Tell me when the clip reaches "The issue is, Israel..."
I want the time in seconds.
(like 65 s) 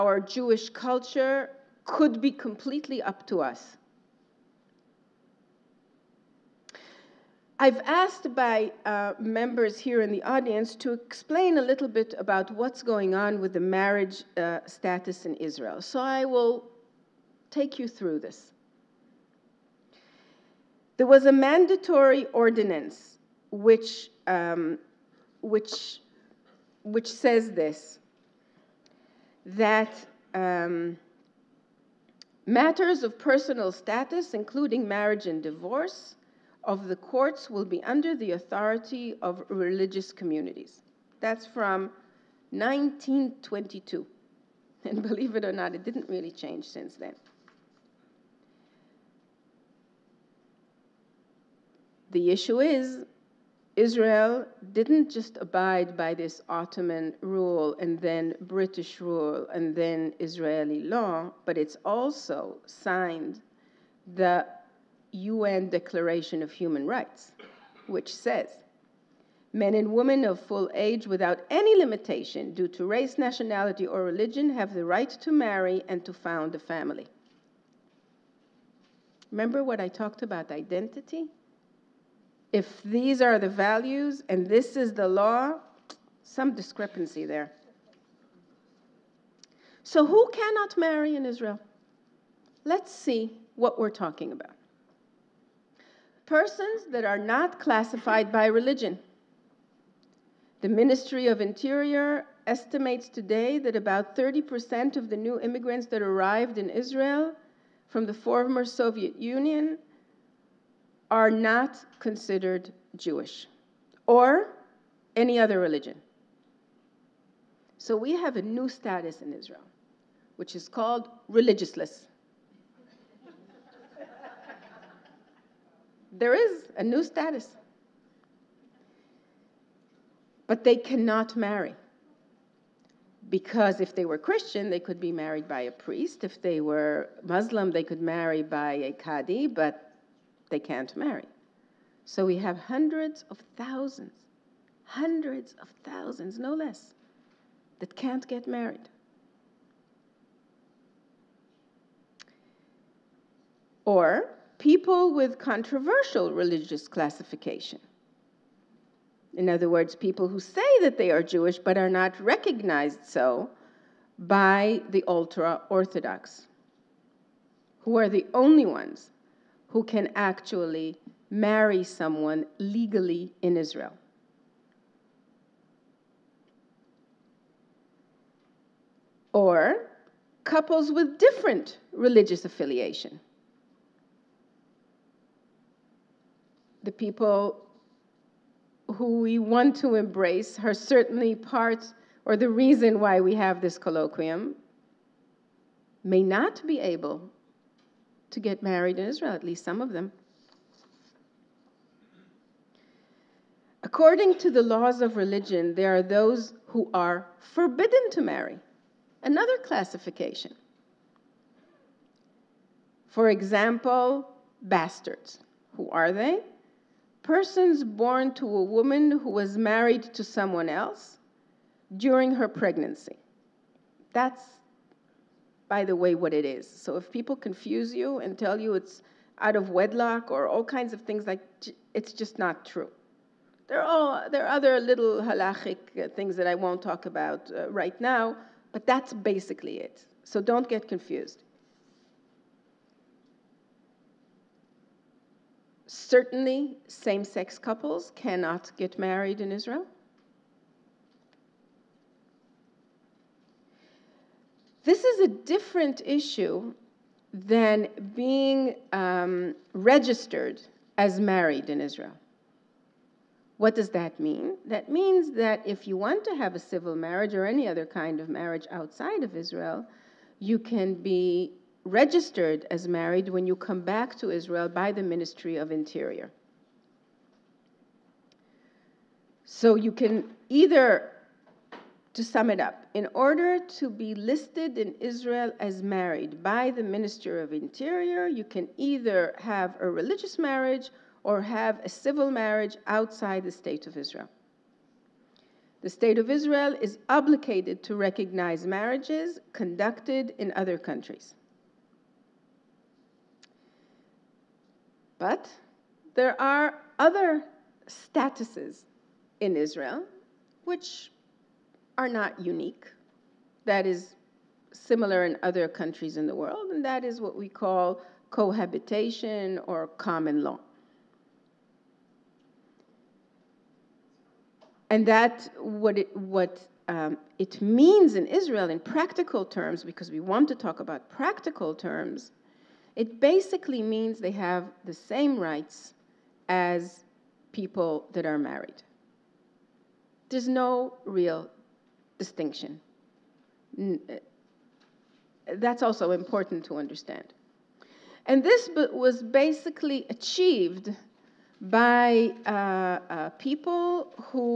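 52 s.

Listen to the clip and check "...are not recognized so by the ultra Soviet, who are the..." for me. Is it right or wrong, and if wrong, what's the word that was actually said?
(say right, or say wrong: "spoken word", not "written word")
wrong: "Orthodox", not "Soviet".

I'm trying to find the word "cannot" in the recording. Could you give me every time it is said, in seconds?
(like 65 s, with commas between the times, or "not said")
90 s, 130 s, 248 s.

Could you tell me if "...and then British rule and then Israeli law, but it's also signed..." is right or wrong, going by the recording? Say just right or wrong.
right.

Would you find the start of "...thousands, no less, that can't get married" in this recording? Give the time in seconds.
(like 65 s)
145 s.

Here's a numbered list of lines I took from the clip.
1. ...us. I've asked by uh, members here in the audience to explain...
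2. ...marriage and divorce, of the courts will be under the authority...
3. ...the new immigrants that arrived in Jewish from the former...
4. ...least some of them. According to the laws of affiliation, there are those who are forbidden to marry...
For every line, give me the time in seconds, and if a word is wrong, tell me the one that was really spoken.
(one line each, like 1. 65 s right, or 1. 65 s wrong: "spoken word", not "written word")
1. 3 s right
2. 34 s right
3. 105 s wrong: "Israel", not "Jewish"
4. 199 s wrong: "religion", not "affiliation".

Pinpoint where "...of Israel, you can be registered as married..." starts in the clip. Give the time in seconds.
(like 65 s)
269 s.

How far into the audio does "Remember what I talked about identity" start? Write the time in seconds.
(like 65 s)
79 s.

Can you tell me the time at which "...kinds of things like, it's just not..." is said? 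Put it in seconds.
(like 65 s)
230 s.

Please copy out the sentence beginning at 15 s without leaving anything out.
So I will take you through this.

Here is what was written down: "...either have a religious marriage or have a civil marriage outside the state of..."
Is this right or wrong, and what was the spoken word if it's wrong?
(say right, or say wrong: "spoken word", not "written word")
right.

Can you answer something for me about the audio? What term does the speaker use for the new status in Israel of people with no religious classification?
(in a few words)
religiousless.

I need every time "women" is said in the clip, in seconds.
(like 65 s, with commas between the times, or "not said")
69 s.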